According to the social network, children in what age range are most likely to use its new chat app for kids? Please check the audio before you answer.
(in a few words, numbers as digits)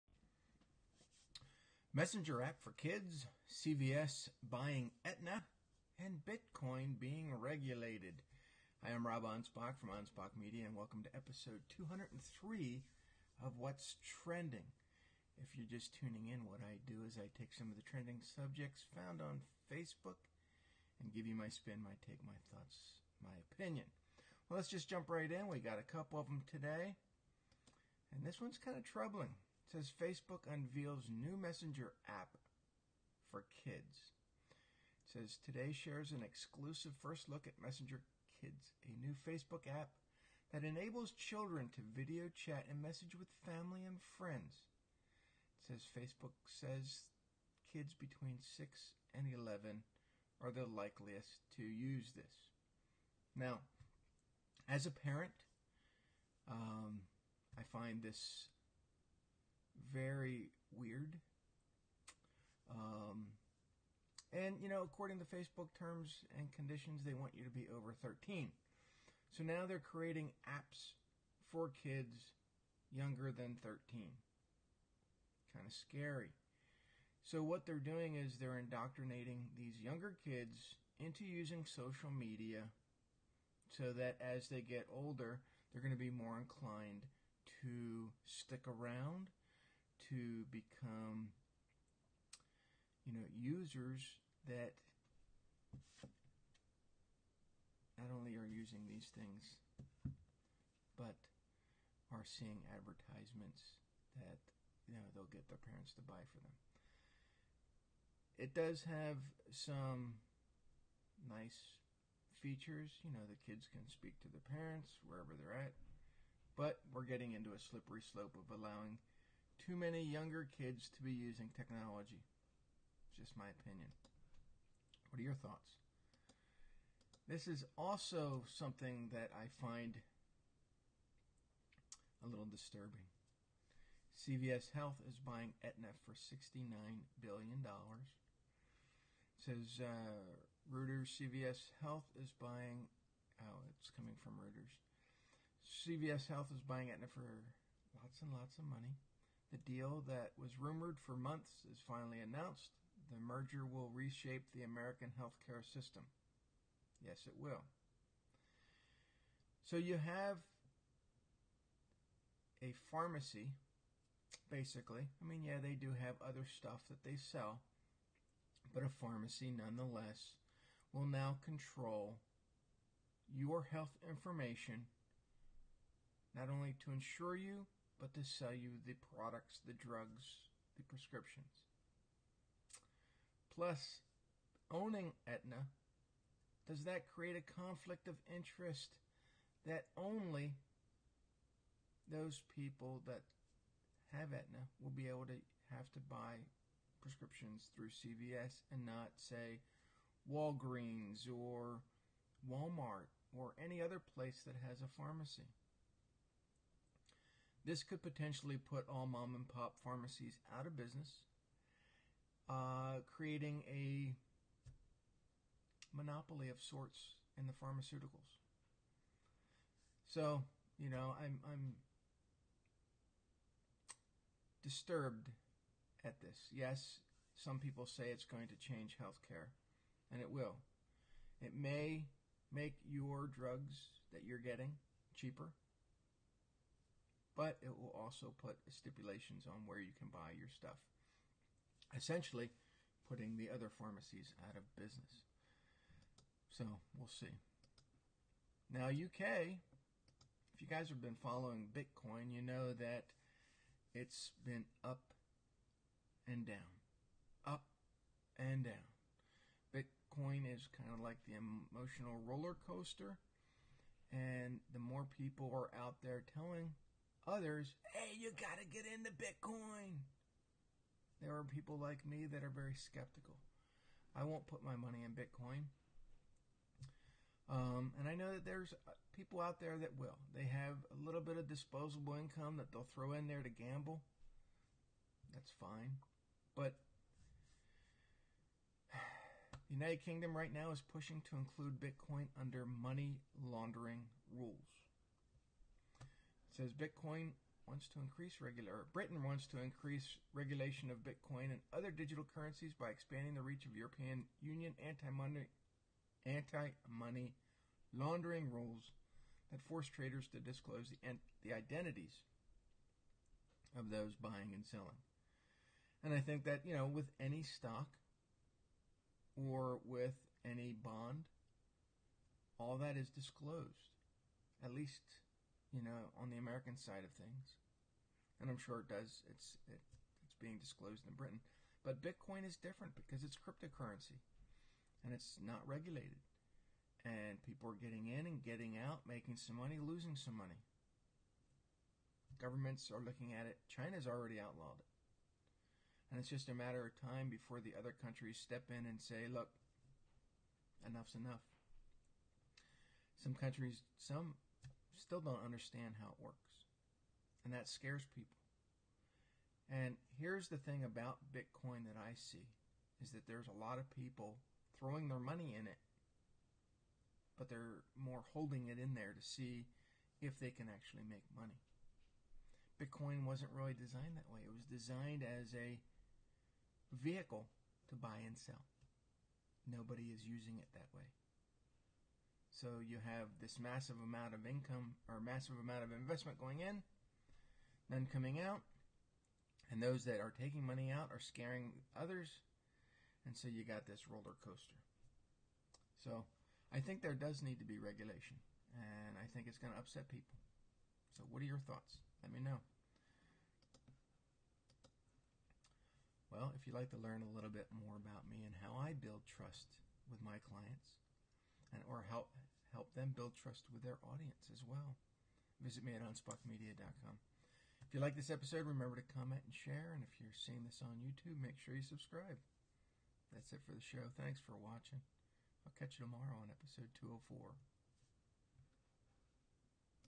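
6 and 11.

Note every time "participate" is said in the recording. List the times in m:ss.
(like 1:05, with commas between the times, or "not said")
not said.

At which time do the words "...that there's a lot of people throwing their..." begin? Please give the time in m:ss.
6:03.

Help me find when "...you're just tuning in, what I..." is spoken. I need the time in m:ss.
0:15.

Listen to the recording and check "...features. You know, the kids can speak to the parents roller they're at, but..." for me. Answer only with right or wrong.
wrong.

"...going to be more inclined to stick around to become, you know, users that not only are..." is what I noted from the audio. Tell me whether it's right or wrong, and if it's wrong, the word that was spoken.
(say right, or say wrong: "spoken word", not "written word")
right.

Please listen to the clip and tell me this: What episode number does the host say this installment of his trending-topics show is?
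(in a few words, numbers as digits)
203.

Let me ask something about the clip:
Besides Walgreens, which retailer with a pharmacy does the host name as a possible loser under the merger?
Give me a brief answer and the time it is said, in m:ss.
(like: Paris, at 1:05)
Walmart, at 3:22.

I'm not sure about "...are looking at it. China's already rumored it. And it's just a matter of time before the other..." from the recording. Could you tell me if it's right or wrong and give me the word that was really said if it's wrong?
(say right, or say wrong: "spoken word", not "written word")
wrong: "outlawed", not "rumored".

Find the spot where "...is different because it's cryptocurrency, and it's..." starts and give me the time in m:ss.
5:32.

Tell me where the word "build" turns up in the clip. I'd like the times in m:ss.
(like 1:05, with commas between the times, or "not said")
6:48, 6:53.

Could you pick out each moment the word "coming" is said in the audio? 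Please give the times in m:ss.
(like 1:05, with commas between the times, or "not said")
2:23, 6:28.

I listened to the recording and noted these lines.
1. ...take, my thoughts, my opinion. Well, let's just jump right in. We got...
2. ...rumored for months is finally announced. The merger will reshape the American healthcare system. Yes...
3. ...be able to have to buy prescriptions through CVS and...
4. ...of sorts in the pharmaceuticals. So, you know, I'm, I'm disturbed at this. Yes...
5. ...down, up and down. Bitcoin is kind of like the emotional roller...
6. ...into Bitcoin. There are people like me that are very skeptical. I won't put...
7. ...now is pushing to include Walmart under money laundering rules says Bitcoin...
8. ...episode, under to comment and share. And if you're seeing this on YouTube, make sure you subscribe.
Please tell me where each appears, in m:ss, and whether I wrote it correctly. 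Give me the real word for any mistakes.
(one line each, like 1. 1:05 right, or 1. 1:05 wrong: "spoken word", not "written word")
1. 0:22 right
2. 2:30 right
3. 3:14 right
4. 3:36 right
5. 4:16 right
6. 4:28 right
7. 4:50 wrong: "Bitcoin", not "Walmart"
8. 6:58 wrong: "remember", not "under".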